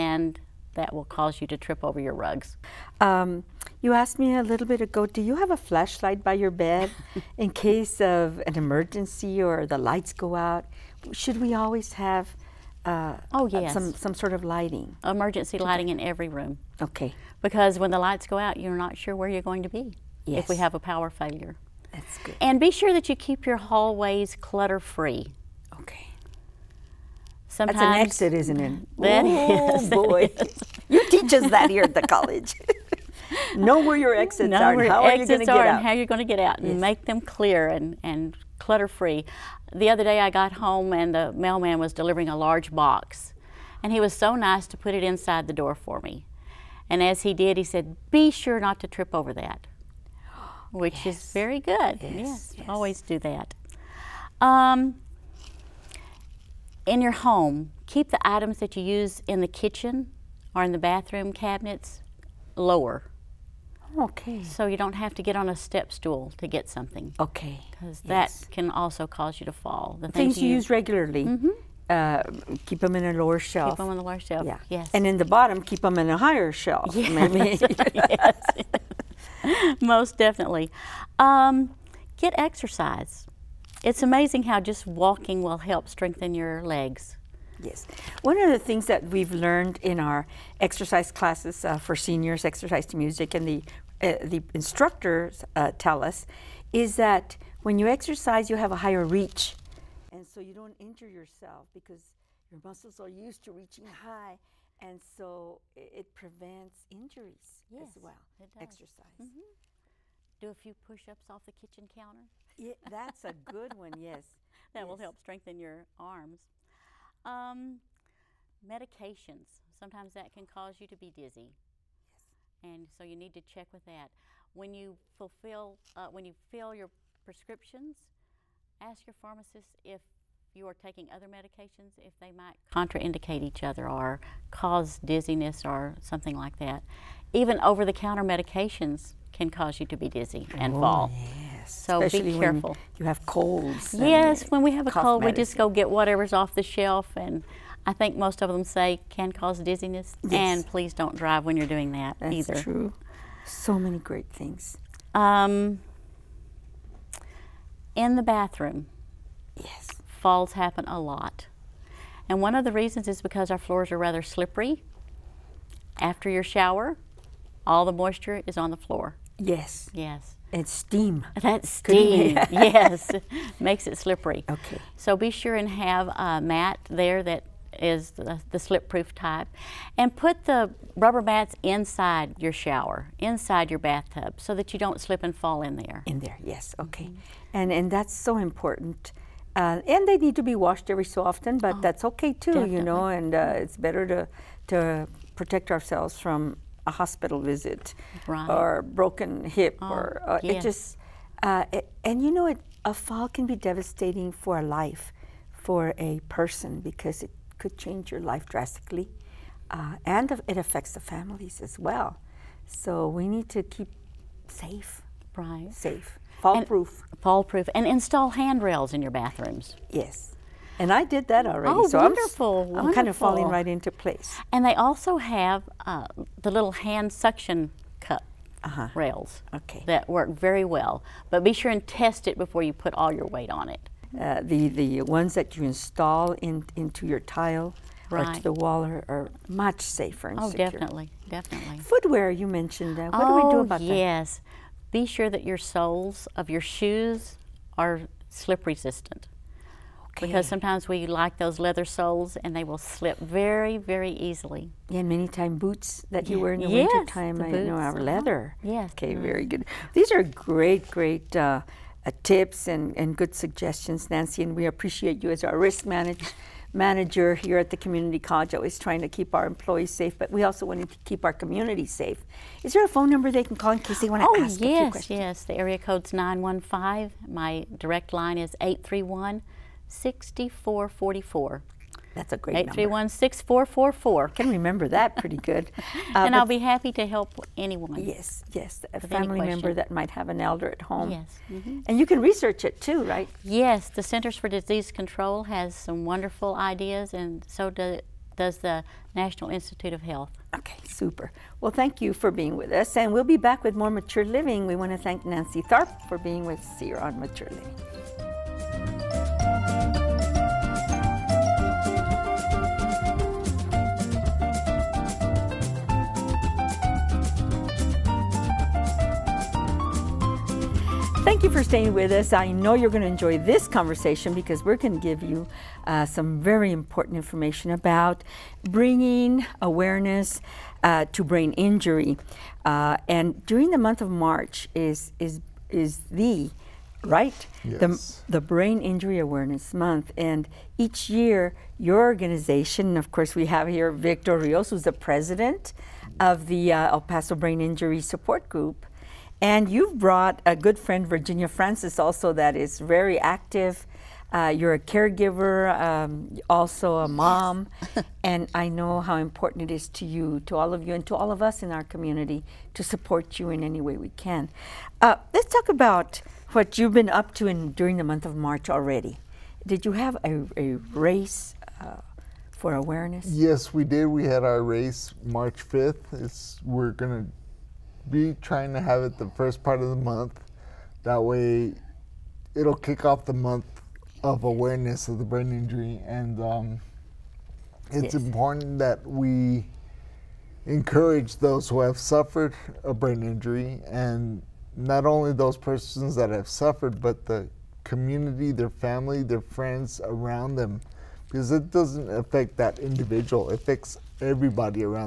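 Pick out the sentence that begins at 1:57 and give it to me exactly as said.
Um, medications, sometimes that can cause you to be dizzy.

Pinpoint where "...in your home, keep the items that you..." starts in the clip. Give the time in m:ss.
0:56.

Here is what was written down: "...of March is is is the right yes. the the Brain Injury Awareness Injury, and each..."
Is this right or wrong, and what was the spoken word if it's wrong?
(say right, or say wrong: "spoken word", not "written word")
wrong: "Month", not "Injury".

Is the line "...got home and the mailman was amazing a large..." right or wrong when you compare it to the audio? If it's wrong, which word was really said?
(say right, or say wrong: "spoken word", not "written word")
wrong: "delivering", not "amazing".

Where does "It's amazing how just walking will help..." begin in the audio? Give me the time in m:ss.
1:23.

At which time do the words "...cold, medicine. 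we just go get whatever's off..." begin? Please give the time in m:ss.
2:24.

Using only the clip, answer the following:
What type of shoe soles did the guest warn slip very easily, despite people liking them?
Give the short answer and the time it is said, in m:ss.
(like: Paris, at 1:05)
Leather soles, at 4:11.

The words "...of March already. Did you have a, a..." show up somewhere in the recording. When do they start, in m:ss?
6:08.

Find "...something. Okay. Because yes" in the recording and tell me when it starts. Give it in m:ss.
1:06.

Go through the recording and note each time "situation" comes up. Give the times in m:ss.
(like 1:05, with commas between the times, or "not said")
not said.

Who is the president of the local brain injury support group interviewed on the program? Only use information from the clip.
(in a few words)
Victor Rios.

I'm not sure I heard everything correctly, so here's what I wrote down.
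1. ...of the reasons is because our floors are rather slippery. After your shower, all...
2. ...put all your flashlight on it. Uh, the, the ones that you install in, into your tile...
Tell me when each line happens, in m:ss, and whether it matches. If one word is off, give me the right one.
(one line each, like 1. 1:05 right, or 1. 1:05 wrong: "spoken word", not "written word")
1. 2:42 right
2. 3:52 wrong: "weight", not "flashlight".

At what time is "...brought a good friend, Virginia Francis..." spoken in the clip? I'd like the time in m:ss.
5:49.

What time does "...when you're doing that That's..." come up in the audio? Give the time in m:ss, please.
2:31.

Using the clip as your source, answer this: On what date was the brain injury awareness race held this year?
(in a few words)
March 5th.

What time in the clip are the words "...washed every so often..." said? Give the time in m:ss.
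3:10.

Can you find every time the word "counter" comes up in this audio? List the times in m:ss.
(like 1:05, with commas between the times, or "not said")
1:51, 2:17.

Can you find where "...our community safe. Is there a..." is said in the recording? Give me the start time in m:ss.
4:31.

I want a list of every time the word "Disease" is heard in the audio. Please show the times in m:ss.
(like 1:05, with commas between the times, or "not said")
4:54.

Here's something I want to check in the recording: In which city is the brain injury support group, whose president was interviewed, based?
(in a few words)
El Paso.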